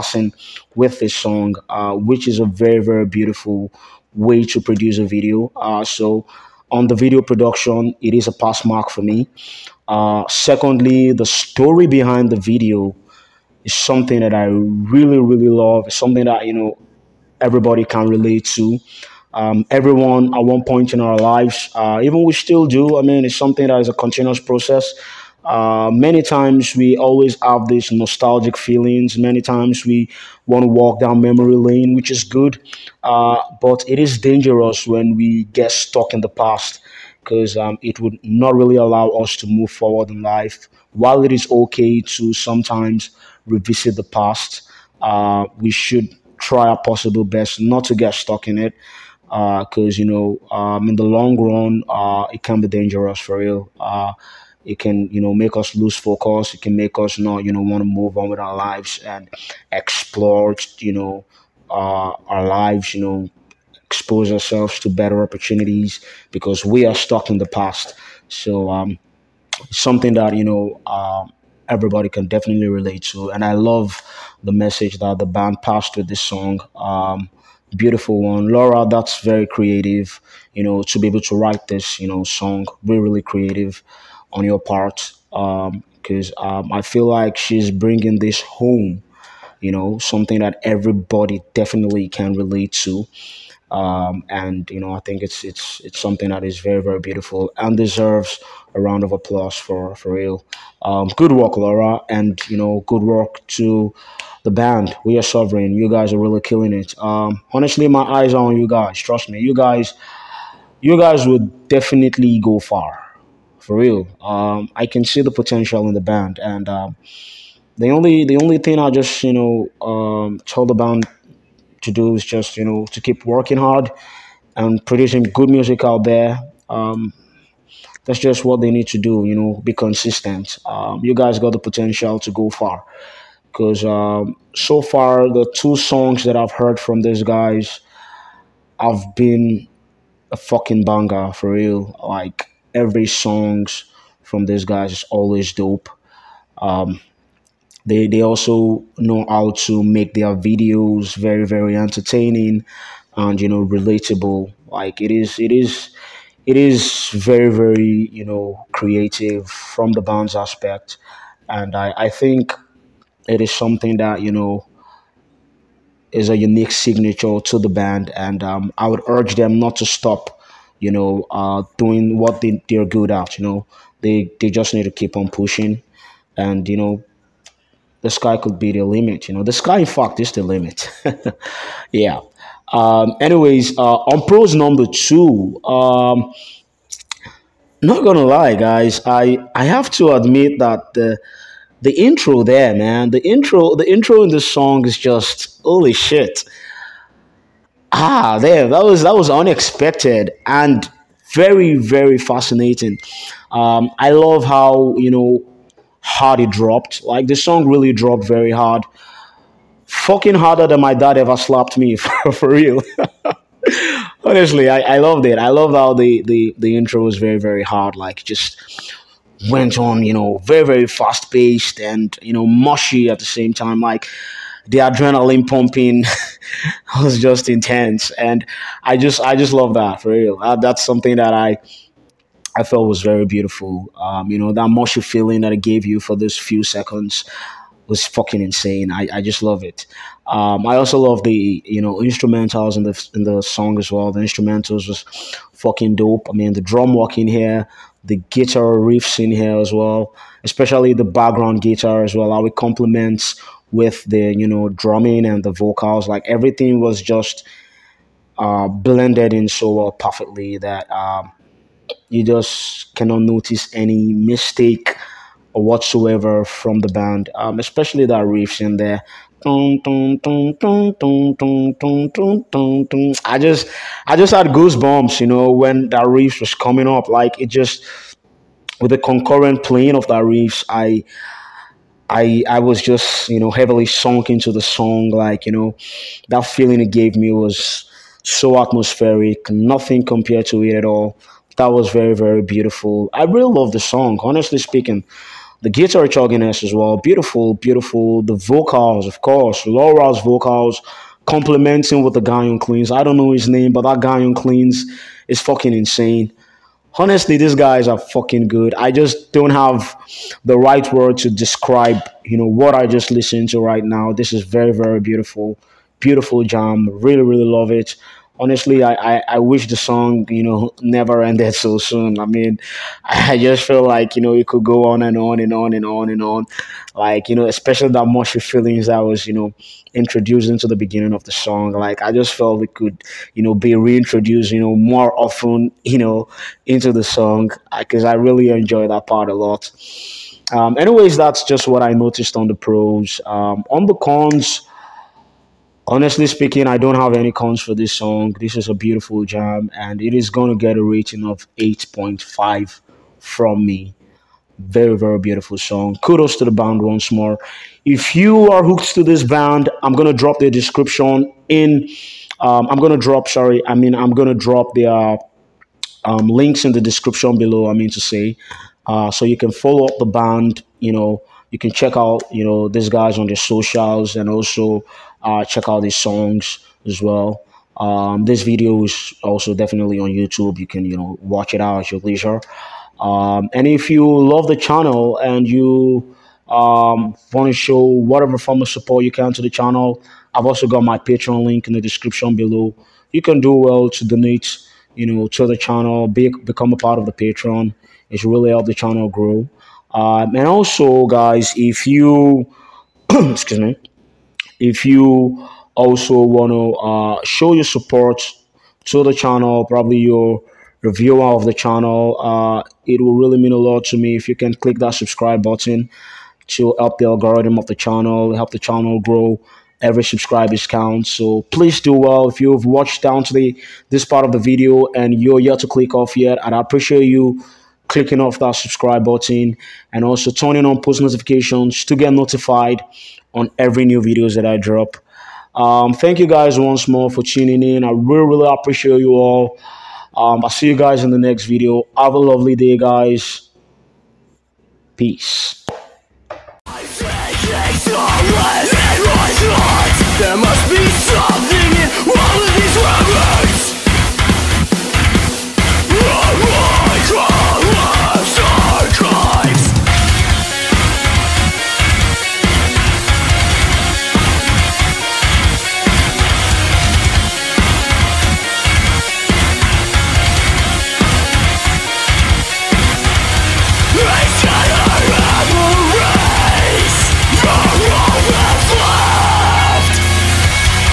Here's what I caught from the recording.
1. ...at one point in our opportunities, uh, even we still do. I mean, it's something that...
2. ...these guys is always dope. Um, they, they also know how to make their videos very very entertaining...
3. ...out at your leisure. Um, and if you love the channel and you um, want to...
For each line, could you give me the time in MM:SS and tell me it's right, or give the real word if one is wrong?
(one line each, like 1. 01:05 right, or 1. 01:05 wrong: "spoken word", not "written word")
1. 00:20 wrong: "lives", not "opportunities"
2. 02:24 right
3. 06:21 right.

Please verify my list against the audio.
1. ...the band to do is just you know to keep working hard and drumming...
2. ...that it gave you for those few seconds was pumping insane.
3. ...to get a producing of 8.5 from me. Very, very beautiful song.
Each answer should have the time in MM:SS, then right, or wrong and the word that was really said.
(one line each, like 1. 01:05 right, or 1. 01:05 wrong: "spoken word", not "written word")
1. 02:00 wrong: "producing", not "drumming"
2. 03:55 wrong: "fucking", not "pumping"
3. 05:50 wrong: "rating", not "producing".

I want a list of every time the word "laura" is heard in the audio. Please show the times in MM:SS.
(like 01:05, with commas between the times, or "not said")
01:18, 01:41, 04:59.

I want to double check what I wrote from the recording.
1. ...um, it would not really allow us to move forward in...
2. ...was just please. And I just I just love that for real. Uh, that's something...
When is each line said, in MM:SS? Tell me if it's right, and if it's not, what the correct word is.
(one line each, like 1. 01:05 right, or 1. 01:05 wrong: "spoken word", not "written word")
1. 00:37 right
2. 03:47 wrong: "intense", not "please".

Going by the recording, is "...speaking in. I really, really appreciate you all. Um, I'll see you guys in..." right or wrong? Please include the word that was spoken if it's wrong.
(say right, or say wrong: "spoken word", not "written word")
wrong: "tuning", not "speaking".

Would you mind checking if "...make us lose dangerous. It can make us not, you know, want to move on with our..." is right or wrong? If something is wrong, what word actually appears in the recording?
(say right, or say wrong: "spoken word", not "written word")
wrong: "focus", not "dangerous".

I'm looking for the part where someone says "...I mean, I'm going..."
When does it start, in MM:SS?
06:03.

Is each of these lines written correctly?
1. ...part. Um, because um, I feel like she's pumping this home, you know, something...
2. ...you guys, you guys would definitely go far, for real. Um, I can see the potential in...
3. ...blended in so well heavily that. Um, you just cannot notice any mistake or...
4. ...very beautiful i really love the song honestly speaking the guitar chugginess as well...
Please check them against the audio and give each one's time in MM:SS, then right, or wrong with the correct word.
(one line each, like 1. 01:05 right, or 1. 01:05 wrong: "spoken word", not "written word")
1. 01:24 wrong: "bringing", not "pumping"
2. 01:49 right
3. 04:18 wrong: "perfectly", not "heavily"
4. 04:52 right.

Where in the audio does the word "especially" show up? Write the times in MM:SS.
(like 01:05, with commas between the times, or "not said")
04:10, 04:27, 05:27.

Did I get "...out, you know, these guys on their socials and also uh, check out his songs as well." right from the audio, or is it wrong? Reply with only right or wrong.
right.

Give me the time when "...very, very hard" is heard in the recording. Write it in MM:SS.
03:37.